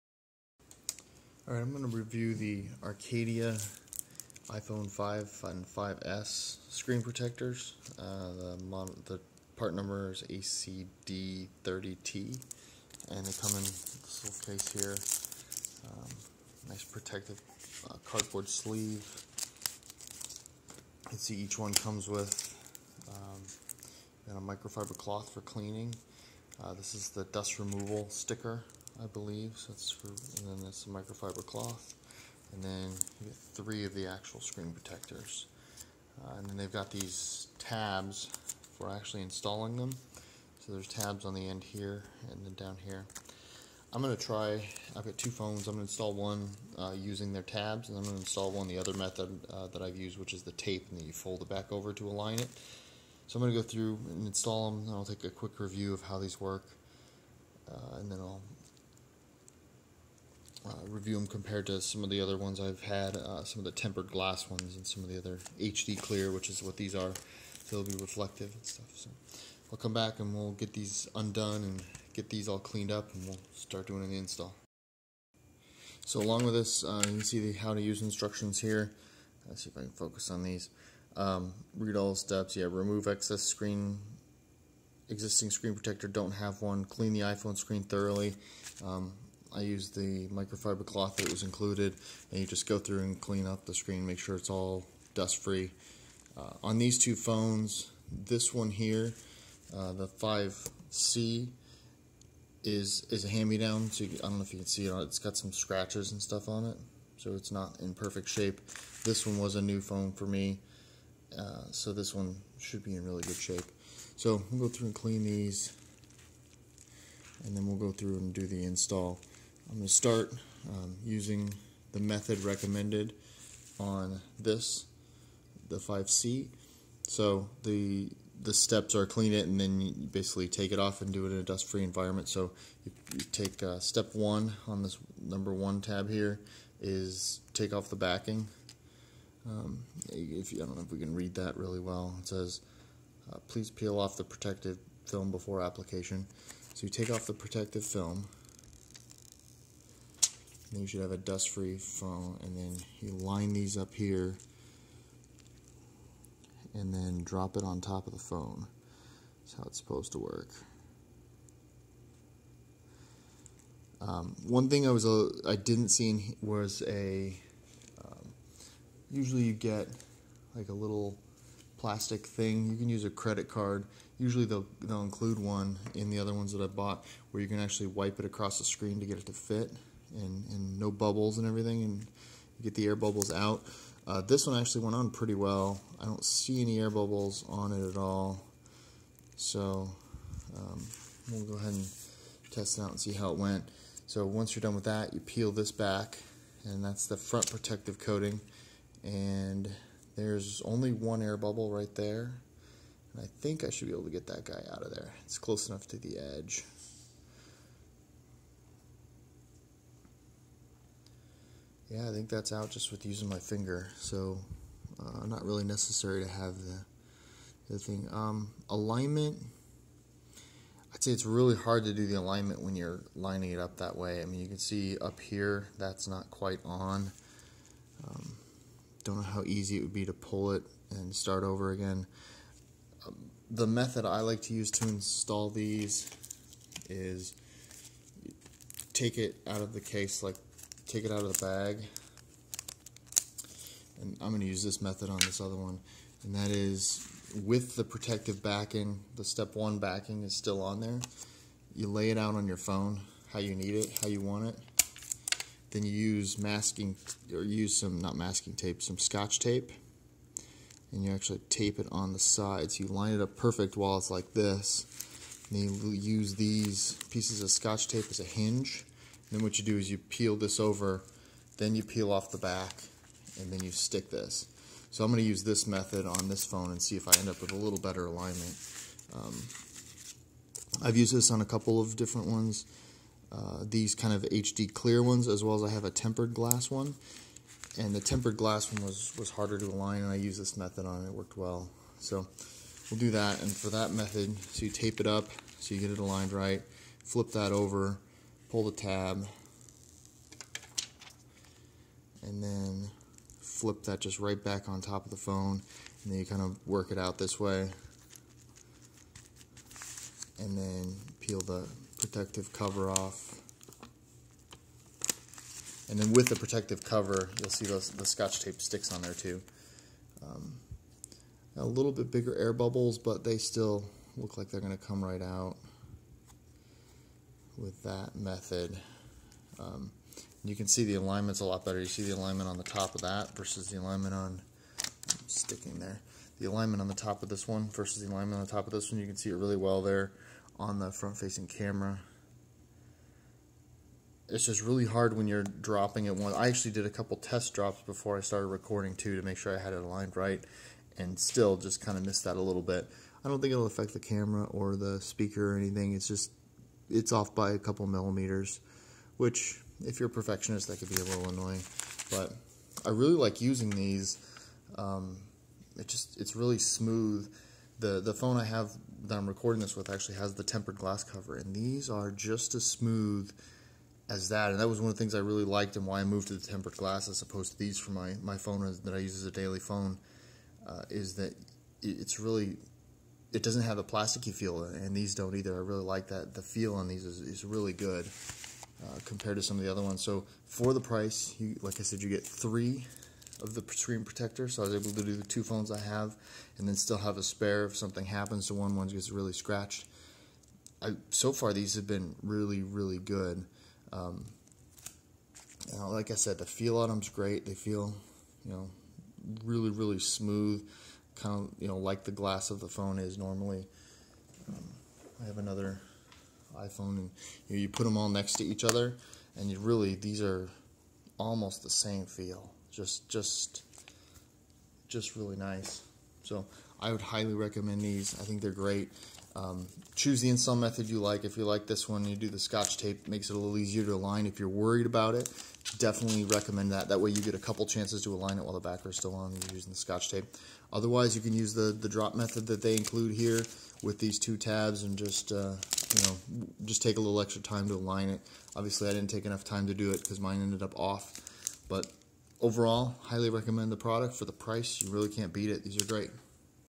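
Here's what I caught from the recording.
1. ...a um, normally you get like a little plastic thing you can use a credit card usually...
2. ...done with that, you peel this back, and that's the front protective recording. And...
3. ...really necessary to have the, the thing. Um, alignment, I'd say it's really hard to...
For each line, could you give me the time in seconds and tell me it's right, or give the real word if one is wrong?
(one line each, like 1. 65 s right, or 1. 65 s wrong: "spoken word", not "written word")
1. 166 s wrong: "usually", not "normally"
2. 194 s wrong: "coating", not "recording"
3. 215 s right.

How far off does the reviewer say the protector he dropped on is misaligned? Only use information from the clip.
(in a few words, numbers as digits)
a couple millimeters.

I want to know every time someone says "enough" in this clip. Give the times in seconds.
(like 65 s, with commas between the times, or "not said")
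205 s, 449 s.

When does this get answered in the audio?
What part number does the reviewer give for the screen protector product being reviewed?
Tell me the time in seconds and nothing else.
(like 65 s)
10 s.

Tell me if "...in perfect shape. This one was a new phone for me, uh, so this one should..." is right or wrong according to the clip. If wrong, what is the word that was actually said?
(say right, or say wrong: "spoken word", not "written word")
right.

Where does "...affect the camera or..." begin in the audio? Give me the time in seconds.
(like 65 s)
353 s.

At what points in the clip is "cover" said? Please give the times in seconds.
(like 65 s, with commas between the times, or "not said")
312 s, 316 s, 371 s.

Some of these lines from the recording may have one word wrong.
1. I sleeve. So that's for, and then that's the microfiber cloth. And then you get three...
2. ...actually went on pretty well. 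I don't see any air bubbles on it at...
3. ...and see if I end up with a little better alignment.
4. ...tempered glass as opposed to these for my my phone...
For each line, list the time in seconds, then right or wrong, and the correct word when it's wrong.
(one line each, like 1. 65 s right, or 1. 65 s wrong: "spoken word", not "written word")
1. 29 s wrong: "believe", not "sleeve"
2. 184 s right
3. 276 s right
4. 376 s right.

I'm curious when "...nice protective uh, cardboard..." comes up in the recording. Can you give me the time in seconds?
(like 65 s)
16 s.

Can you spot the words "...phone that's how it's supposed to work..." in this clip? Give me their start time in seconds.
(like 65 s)
158 s.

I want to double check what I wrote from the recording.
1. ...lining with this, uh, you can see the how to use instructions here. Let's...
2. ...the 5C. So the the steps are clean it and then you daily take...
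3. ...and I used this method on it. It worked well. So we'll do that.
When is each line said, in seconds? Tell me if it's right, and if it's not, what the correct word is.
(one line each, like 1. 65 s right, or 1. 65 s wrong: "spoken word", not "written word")
1. 76 s wrong: "along", not "lining"
2. 125 s wrong: "basically", not "daily"
3. 290 s right.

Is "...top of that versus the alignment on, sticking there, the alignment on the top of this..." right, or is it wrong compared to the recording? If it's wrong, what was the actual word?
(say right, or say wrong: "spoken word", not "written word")
right.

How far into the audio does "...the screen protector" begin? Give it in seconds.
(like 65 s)
393 s.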